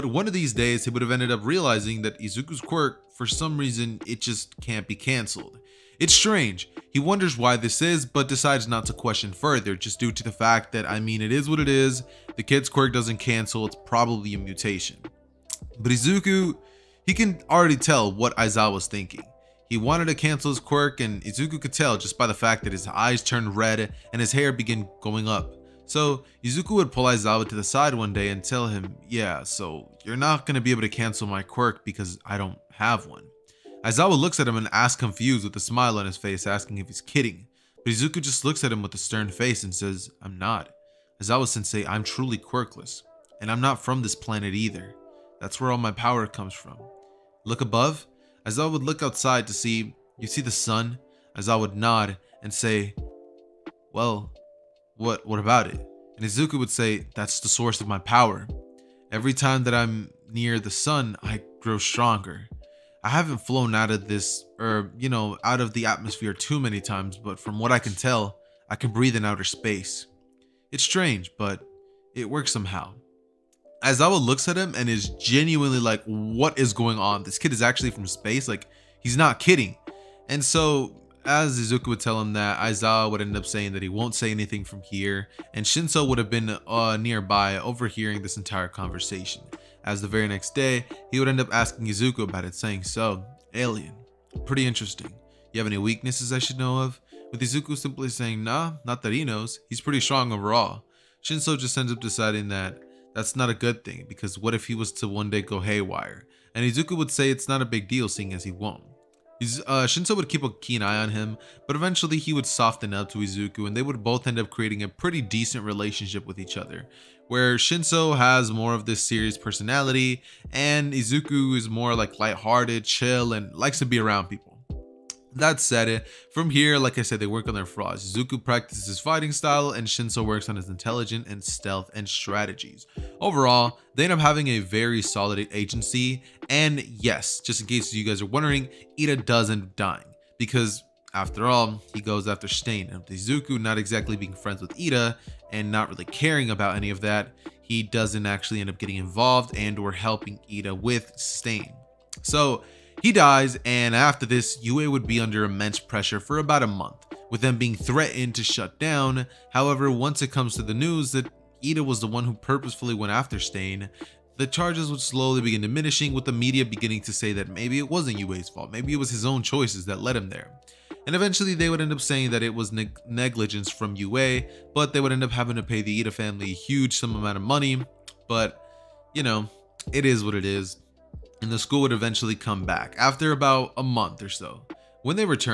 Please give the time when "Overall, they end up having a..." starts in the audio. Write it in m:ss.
2:13.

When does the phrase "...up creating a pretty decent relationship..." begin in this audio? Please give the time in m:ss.
1:54.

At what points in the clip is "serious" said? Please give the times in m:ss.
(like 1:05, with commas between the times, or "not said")
1:59.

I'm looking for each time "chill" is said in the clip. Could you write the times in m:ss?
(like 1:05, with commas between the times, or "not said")
2:02.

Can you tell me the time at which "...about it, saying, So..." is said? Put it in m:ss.
1:32.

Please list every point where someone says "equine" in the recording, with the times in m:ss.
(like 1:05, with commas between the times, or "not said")
not said.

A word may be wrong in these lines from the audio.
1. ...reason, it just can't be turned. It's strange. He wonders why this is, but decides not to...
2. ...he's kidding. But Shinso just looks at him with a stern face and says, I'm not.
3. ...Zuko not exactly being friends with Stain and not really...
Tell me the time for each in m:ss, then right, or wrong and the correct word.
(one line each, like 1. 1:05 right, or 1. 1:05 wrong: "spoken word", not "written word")
1. 0:03 wrong: "cancelled", not "turned"
2. 0:36 wrong: "Izuku", not "Shinso"
3. 2:23 wrong: "Iida", not "Stain".